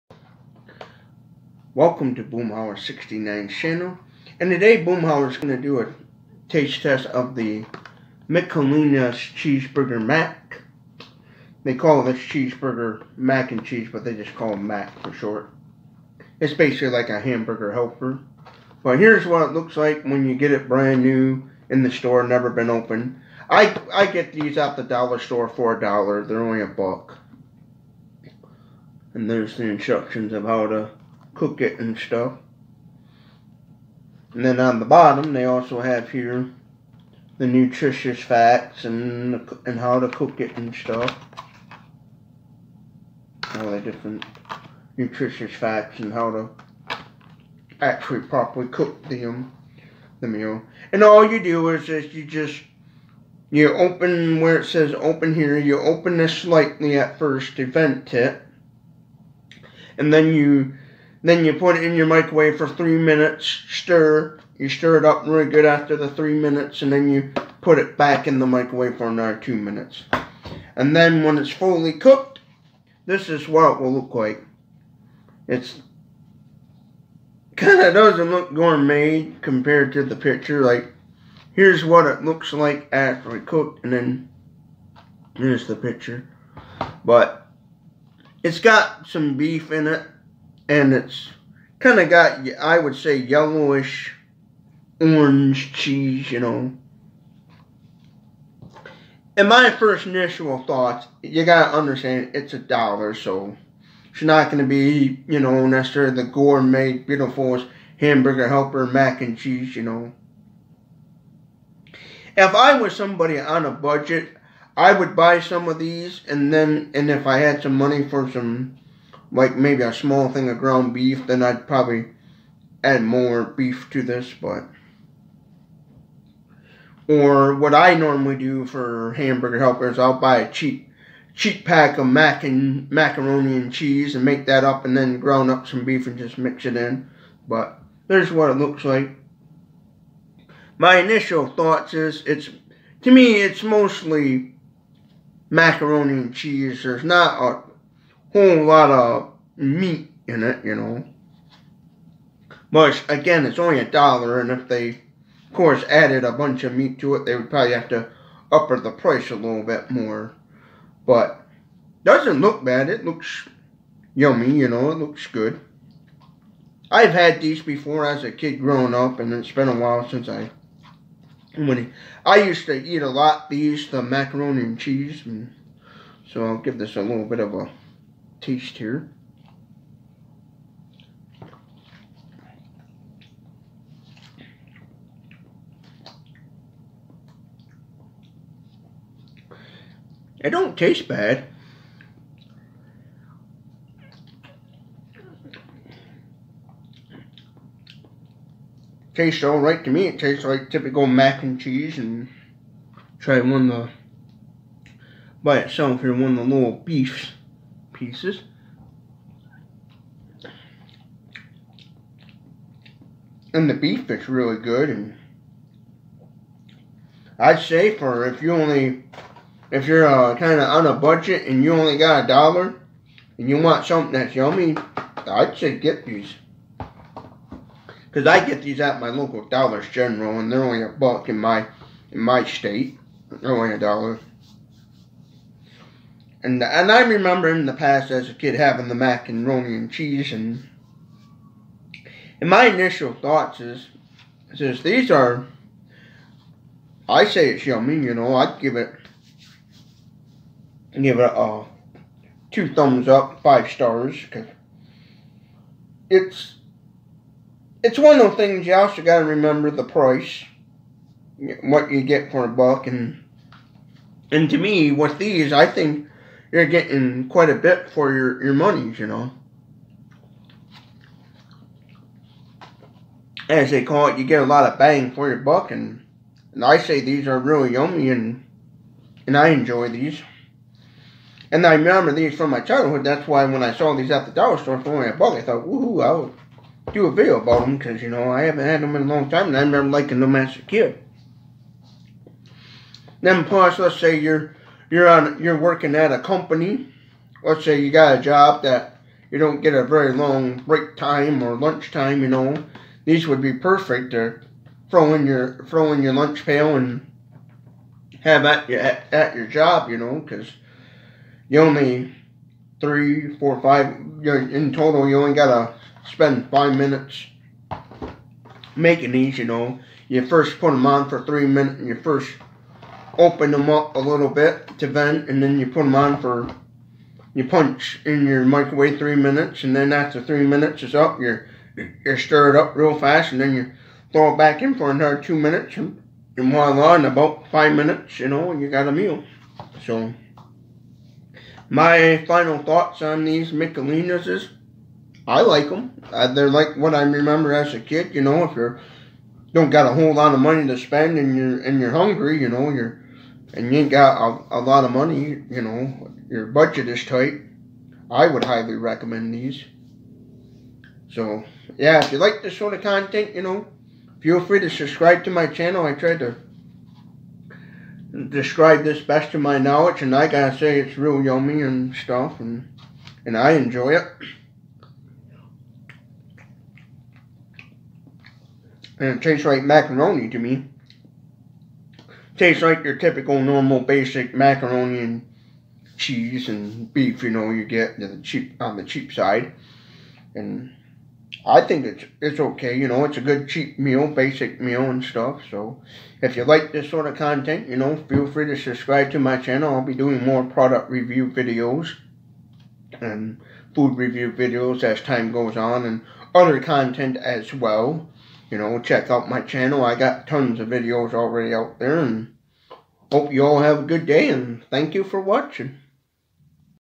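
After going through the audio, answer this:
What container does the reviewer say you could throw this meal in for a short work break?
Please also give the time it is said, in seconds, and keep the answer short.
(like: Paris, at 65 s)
lunch pail, at 306 s.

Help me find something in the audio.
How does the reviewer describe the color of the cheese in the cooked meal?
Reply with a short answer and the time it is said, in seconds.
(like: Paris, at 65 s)
yellowish orange, at 93 s.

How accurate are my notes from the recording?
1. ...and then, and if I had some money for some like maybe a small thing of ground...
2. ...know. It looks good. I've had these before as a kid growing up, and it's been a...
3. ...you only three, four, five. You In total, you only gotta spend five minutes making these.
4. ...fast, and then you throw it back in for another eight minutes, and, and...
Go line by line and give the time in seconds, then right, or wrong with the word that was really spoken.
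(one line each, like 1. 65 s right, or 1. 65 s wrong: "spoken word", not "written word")
1. 116 s right
2. 164 s right
3. 311 s right
4. 332 s wrong: "two", not "eight".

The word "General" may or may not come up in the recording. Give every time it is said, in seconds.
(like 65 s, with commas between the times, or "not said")
229 s.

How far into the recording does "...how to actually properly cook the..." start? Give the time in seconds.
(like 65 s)
46 s.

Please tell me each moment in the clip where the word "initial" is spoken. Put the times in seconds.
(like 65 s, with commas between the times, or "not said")
100 s, 140 s, 242 s.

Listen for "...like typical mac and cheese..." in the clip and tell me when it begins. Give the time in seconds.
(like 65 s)
200 s.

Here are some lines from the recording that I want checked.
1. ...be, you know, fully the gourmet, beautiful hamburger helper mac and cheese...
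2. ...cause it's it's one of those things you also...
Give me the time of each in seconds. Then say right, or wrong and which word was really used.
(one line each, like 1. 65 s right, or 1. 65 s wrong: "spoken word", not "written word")
1. 104 s wrong: "necessarily", not "fully"
2. 254 s right.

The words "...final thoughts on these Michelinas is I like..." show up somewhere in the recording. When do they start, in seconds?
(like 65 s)
342 s.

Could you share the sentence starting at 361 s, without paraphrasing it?
So, yeah, if you like this sort of content, you know, feel free to subscribe to my channel.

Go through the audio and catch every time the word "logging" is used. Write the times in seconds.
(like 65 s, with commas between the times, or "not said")
not said.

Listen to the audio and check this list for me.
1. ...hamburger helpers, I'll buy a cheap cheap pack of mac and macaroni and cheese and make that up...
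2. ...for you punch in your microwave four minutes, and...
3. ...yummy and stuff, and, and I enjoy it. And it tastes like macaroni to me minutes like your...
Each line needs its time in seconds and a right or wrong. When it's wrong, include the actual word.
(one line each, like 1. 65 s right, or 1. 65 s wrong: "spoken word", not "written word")
1. 129 s right
2. 326 s wrong: "three", not "four"
3. 371 s wrong: "tastes", not "minutes".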